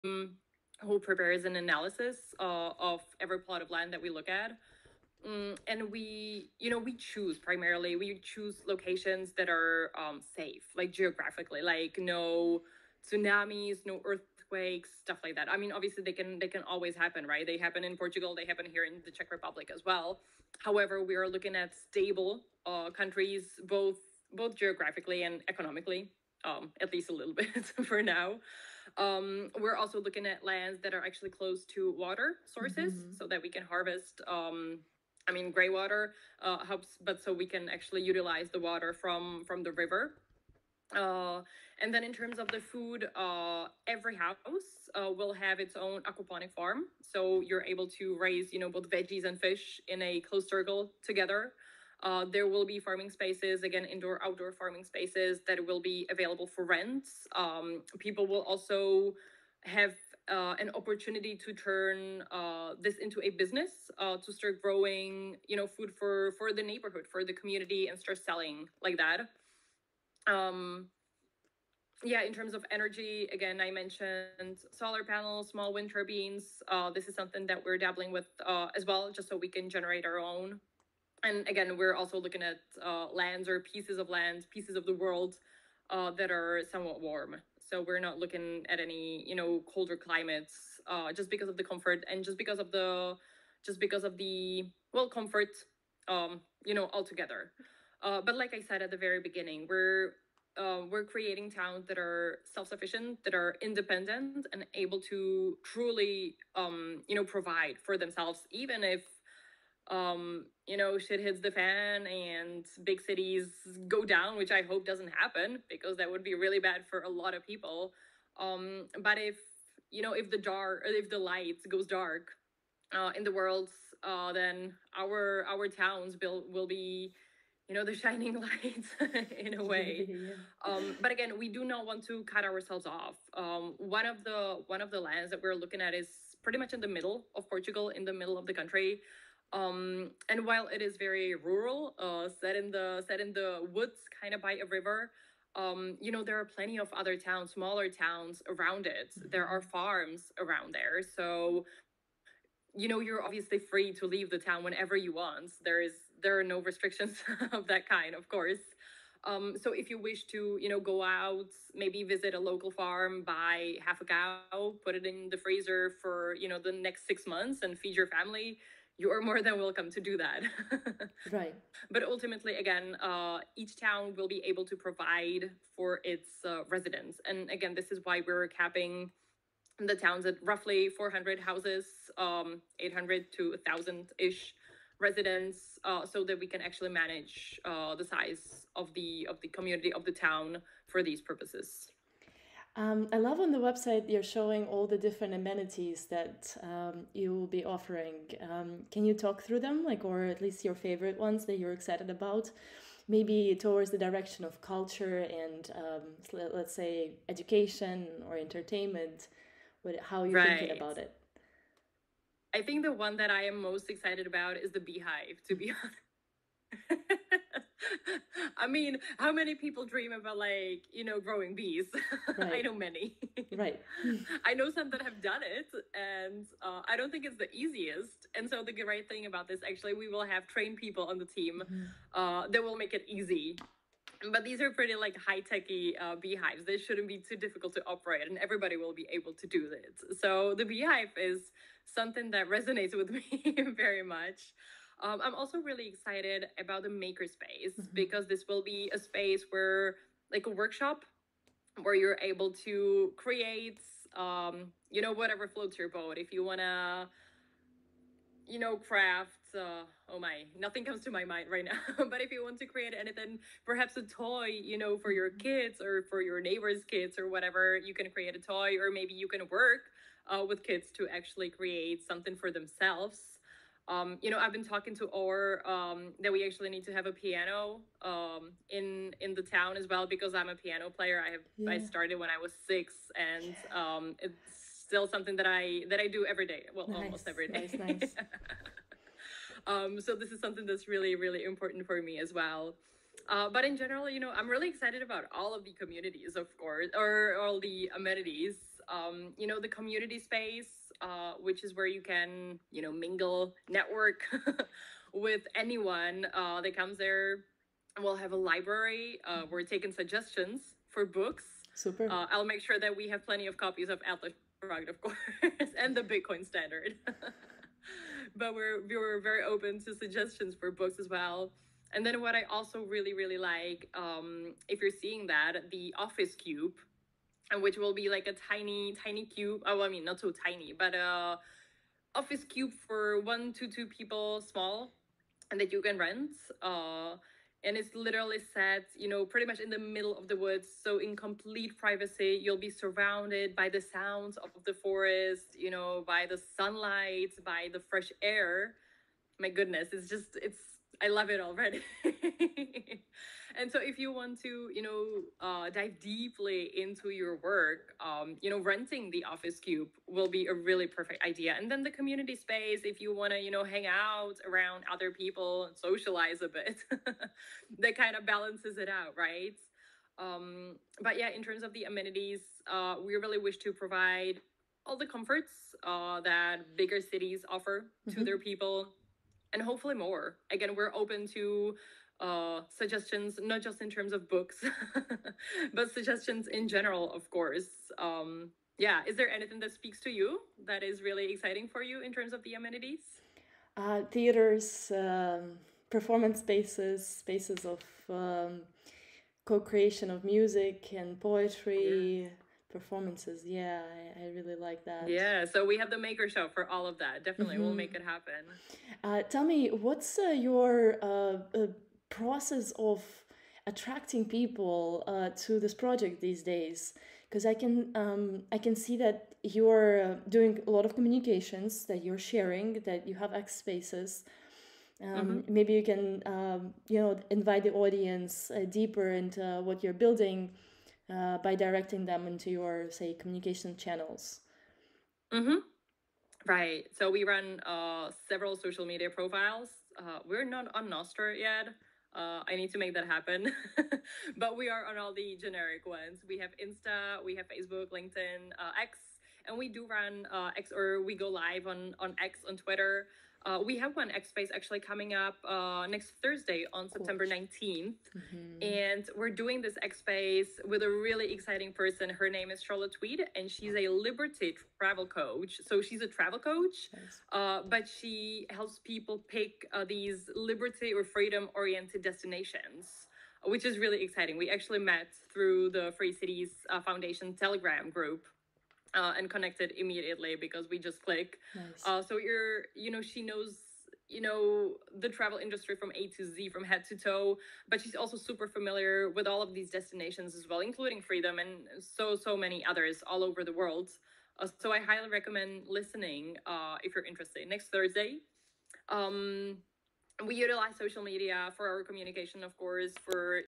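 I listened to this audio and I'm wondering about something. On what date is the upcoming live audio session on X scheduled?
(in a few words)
September 19th.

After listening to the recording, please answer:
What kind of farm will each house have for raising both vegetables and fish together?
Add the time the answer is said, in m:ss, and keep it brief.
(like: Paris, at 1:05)
Aquaponic farm, at 0:46.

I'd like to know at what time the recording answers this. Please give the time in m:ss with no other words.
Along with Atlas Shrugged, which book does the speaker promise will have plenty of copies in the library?
5:15.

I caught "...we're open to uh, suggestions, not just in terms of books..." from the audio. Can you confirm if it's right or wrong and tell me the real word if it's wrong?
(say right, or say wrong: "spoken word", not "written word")
right.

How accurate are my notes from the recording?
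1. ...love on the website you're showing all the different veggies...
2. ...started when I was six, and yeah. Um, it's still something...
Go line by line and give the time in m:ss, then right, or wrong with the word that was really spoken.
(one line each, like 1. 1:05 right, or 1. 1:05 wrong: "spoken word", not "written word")
1. 3:13 wrong: "amenities", not "veggies"
2. 4:41 right.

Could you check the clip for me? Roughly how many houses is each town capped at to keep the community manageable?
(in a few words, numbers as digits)
400.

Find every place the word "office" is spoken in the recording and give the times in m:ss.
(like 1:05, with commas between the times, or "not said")
5:25, 5:32, 5:59.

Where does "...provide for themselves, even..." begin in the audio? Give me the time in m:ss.
1:47.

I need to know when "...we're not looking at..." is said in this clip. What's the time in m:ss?
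1:27.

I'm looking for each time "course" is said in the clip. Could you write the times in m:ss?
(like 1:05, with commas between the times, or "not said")
2:38, 4:56, 5:15, 6:27, 8:22.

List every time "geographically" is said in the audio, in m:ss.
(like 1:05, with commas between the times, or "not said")
0:10, 0:24.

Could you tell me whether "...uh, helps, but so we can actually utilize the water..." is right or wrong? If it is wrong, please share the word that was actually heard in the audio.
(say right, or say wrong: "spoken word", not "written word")
right.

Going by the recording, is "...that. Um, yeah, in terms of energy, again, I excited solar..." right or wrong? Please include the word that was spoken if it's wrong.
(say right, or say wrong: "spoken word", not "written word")
wrong: "mentioned", not "excited".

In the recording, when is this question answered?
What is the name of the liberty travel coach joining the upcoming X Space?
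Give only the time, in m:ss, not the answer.
7:42.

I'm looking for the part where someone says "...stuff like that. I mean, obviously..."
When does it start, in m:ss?
0:15.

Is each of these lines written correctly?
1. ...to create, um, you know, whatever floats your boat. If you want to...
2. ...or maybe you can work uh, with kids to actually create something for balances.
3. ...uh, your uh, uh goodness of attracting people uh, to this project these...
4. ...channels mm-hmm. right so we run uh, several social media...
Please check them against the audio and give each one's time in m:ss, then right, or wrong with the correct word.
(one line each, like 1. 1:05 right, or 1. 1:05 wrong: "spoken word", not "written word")
1. 4:12 right
2. 4:28 wrong: "themselves", not "balances"
3. 6:50 wrong: "process", not "goodness"
4. 7:13 right.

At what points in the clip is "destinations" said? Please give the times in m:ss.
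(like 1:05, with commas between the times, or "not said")
7:52, 8:09.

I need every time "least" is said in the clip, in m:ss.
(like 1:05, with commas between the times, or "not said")
0:26, 3:20.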